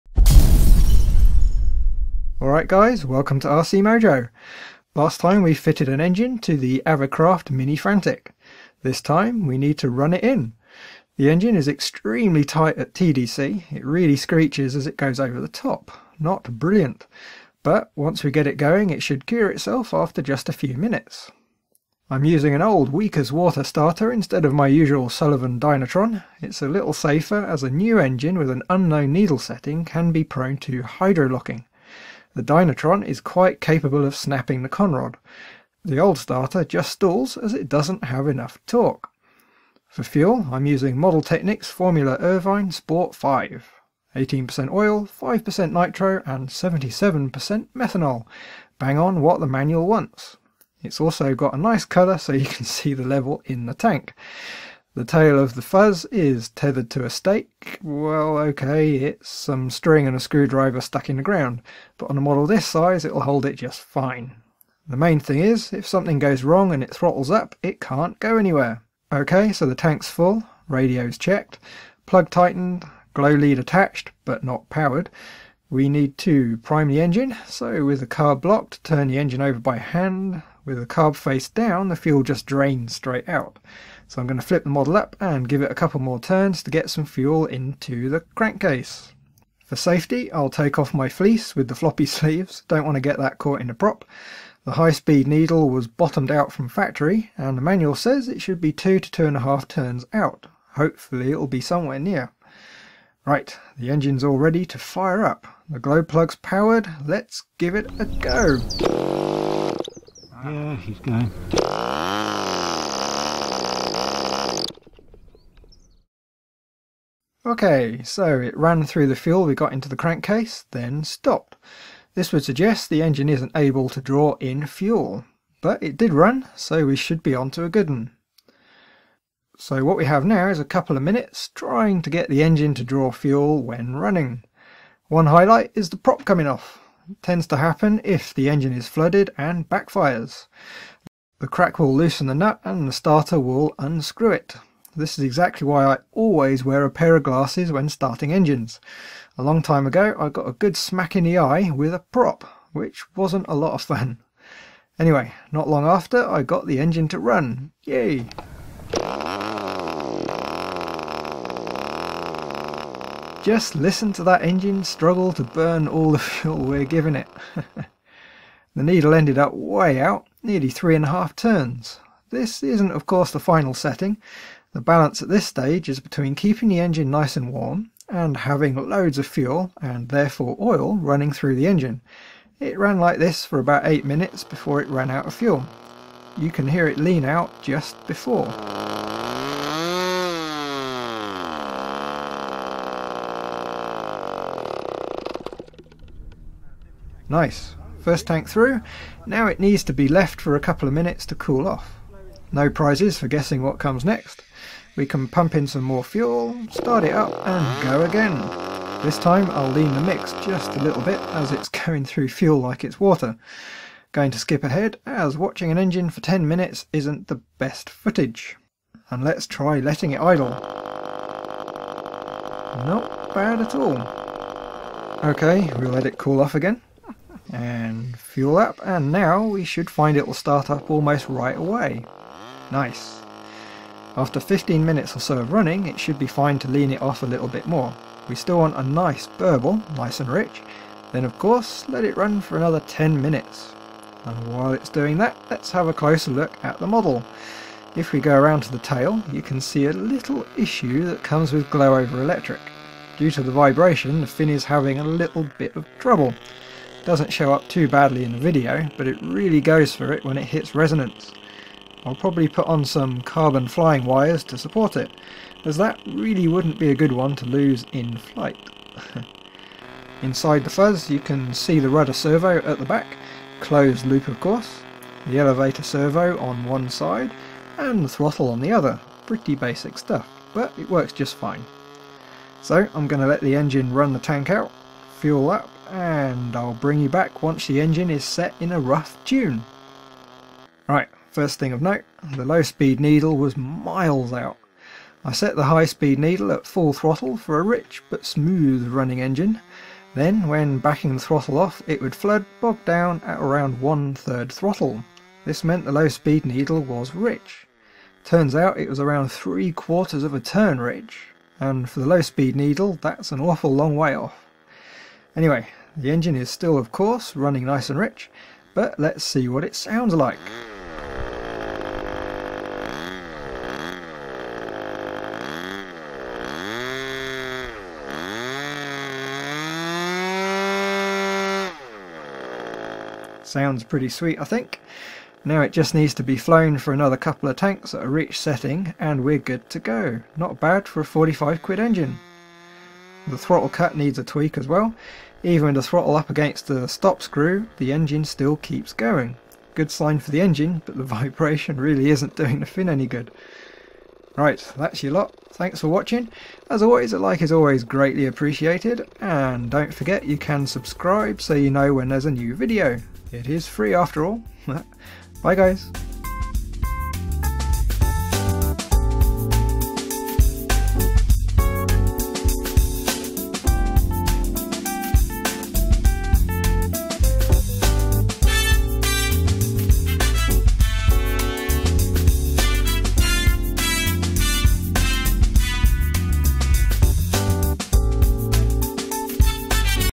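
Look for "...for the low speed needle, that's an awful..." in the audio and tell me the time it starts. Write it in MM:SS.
05:11.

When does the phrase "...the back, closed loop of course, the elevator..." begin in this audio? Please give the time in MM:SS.
04:32.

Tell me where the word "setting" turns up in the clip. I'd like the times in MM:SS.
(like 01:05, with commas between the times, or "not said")
00:29, 02:53, 05:38.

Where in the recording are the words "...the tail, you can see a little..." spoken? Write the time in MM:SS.
04:08.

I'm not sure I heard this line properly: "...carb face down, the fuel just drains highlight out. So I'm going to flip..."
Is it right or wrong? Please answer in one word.
wrong.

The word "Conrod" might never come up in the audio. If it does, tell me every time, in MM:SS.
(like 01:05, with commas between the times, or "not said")
00:34.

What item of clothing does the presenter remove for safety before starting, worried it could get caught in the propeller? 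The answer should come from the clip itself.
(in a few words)
Fleece.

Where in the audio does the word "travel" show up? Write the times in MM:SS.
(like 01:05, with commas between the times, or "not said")
not said.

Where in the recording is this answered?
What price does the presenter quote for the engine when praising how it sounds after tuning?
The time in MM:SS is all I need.
05:41.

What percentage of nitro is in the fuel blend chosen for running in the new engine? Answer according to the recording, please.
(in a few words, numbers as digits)
5%.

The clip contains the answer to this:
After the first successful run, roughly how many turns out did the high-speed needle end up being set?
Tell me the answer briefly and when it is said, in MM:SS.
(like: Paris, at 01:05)
3.5 turns, at 02:50.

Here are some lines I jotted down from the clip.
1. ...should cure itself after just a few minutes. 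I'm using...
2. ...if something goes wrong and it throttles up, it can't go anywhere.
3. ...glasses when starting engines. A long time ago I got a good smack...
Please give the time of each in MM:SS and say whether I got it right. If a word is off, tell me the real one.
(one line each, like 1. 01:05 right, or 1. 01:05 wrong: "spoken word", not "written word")
1. 00:19 right
2. 01:05 right
3. 02:27 right.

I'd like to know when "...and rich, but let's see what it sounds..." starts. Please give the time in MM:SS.
05:17.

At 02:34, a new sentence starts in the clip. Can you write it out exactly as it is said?
Anyway, not long after I got the engine to run.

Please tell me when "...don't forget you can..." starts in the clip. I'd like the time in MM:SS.
05:59.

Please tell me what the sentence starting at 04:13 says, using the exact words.
Due to the vibration, the fin is having a little bit of trouble.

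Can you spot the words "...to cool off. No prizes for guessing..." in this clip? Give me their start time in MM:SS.
03:21.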